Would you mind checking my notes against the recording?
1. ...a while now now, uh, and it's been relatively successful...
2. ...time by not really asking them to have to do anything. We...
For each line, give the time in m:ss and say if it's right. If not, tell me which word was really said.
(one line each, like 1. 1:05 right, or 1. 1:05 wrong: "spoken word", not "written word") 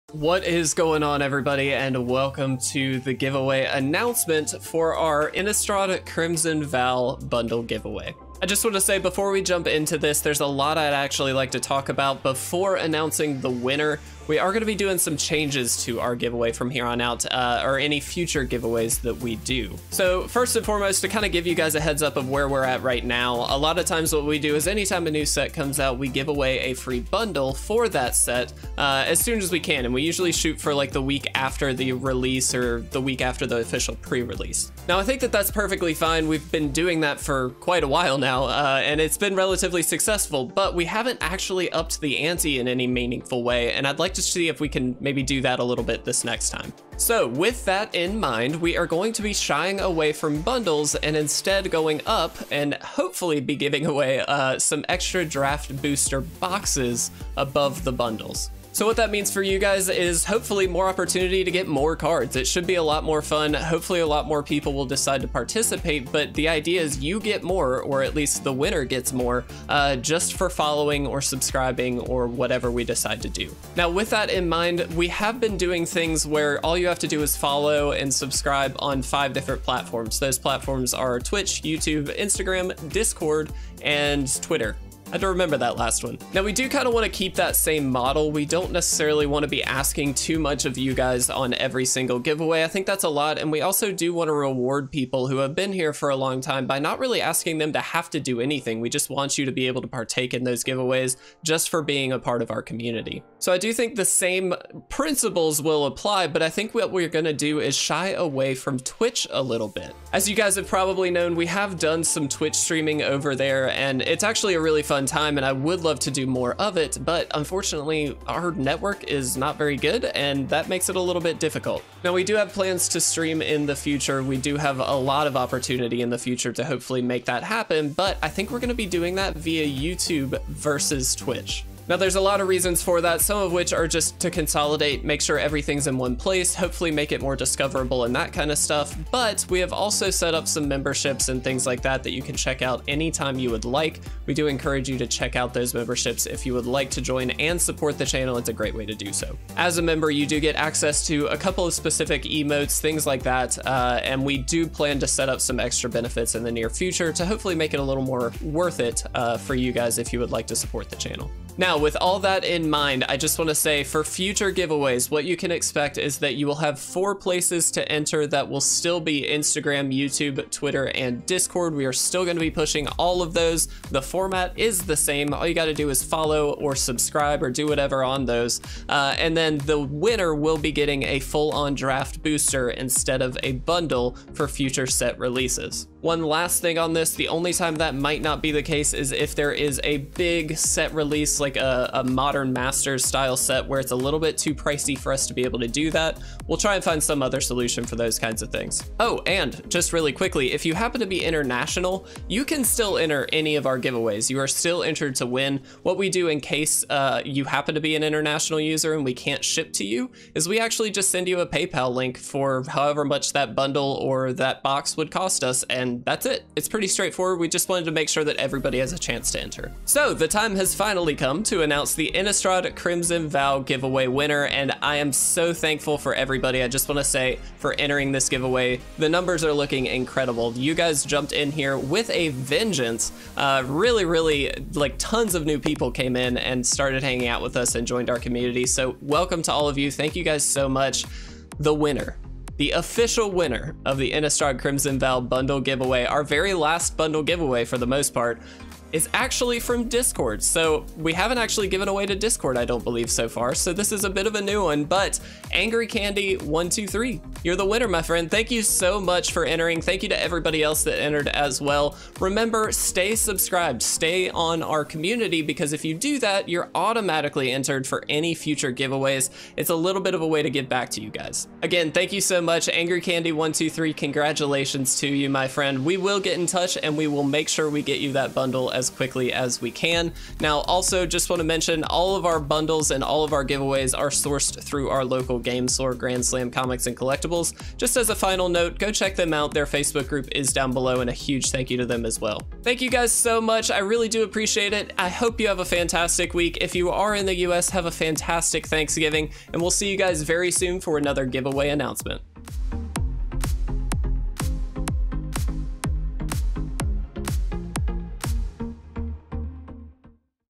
1. 0:37 right
2. 1:36 right.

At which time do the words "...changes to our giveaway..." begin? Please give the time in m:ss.
0:15.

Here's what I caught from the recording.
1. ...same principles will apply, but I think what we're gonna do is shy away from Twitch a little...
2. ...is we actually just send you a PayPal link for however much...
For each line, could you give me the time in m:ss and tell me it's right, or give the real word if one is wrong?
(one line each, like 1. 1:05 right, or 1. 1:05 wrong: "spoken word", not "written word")
1. 1:44 right
2. 3:30 right.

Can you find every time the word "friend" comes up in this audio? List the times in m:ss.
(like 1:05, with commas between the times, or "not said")
4:18, 4:35.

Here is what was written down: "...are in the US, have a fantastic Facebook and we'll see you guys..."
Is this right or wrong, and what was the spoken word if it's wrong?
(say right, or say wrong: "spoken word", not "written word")
wrong: "Thanksgiving", not "Facebook".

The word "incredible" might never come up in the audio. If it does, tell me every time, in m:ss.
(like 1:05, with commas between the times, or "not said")
3:49.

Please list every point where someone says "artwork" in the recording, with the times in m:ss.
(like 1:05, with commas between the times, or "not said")
not said.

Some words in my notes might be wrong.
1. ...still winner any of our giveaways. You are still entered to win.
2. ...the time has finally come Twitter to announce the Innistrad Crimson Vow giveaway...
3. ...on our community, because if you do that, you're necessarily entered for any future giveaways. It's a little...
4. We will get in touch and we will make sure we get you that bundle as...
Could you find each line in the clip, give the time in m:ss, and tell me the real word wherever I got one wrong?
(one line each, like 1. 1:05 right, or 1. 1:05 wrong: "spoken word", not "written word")
1. 3:22 wrong: "enter", not "winner"
2. 3:40 wrong: "Kingdom", not "Twitter"
3. 4:24 wrong: "automatically", not "necessarily"
4. 4:35 right.